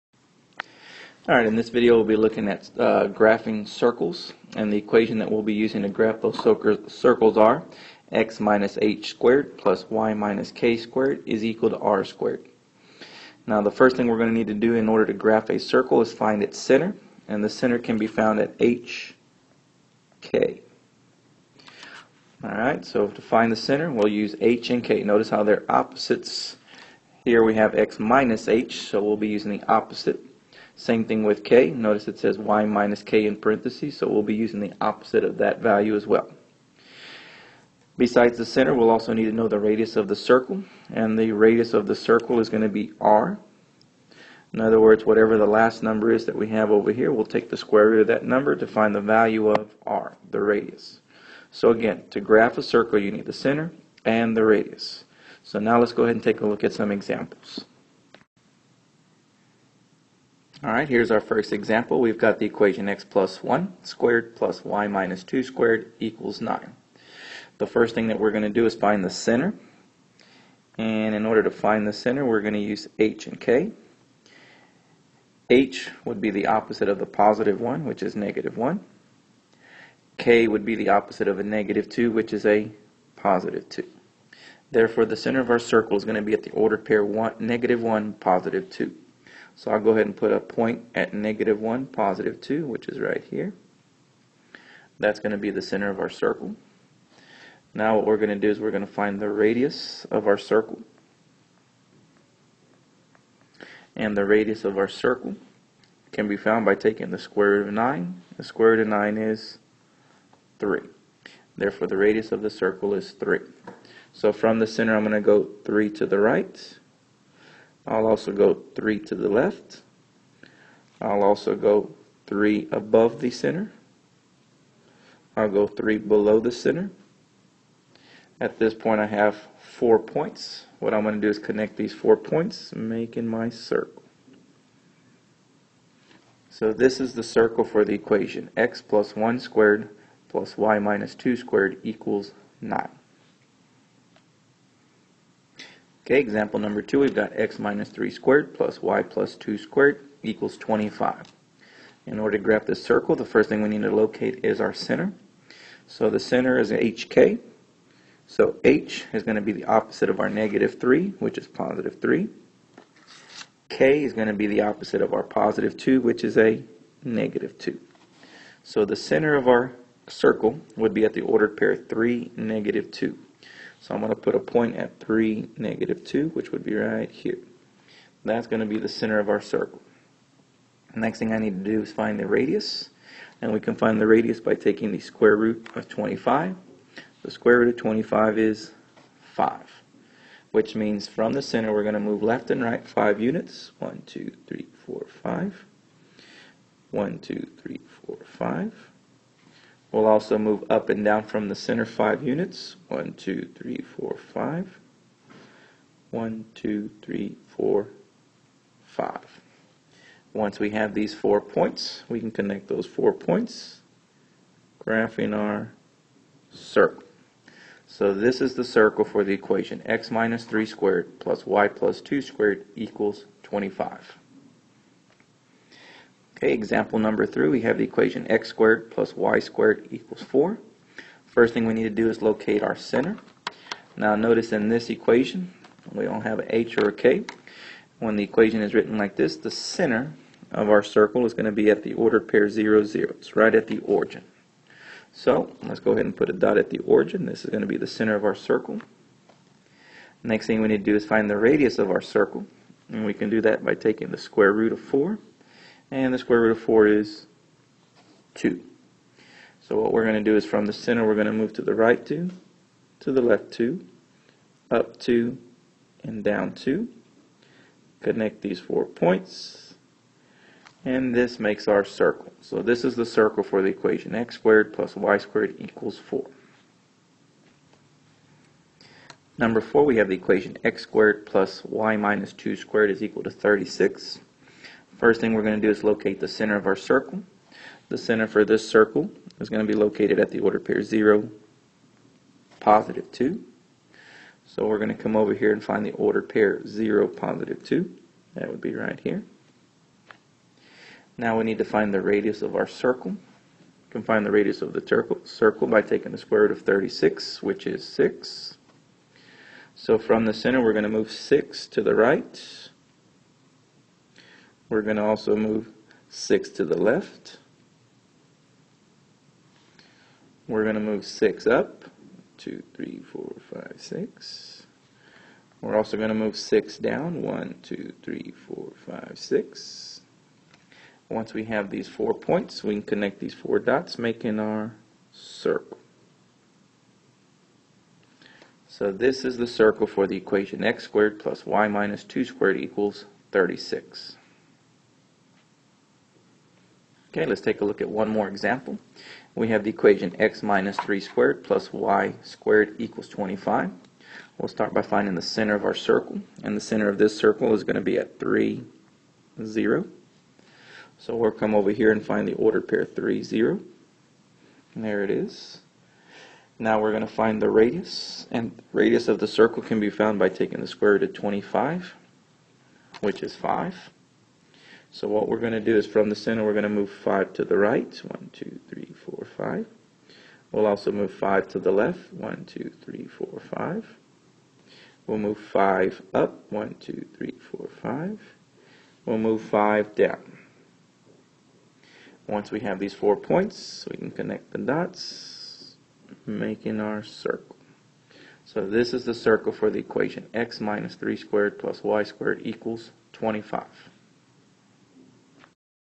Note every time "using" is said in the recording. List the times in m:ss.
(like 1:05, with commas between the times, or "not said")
0:05, 0:29, 0:34.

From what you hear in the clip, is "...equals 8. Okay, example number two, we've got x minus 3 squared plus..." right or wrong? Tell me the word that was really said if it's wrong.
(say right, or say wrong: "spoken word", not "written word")
wrong: "9", not "8".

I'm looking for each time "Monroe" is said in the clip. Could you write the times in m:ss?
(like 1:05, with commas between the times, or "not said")
not said.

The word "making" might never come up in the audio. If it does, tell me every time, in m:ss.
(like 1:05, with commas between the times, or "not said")
2:12, 5:33, 6:36.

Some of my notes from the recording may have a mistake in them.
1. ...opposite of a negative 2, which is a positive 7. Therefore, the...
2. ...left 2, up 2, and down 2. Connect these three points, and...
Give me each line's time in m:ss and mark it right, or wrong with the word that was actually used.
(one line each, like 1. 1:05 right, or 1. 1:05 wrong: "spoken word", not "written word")
1. 1:20 wrong: "2", not "7"
2. 4:23 wrong: "four", not "three".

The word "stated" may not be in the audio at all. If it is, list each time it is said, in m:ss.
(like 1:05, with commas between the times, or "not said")
not said.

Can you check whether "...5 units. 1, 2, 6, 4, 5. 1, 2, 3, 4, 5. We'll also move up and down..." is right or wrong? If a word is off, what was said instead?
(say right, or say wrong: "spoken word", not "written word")
wrong: "3", not "6".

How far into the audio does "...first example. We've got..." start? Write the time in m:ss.
1:01.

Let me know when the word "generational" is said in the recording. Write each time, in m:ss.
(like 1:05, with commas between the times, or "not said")
not said.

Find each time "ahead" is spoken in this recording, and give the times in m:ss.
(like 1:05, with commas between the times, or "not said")
0:56, 1:29, 4:05.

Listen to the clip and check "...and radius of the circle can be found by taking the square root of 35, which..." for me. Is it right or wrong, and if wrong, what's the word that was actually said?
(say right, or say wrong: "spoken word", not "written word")
wrong: "25", not "35".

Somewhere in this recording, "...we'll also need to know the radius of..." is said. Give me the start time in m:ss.
0:38.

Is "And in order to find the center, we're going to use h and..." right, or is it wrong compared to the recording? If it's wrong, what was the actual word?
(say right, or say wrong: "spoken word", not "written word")
right.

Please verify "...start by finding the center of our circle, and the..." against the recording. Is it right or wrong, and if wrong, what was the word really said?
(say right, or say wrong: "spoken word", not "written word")
right.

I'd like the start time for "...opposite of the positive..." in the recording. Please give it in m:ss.
1:16.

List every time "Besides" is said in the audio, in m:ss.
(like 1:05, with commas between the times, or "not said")
0:37.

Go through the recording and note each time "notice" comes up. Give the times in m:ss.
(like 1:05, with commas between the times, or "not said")
0:25, 0:31, 3:54.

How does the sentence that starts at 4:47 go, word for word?
The center for this circle is going to be located at the order pair 0, positive 2.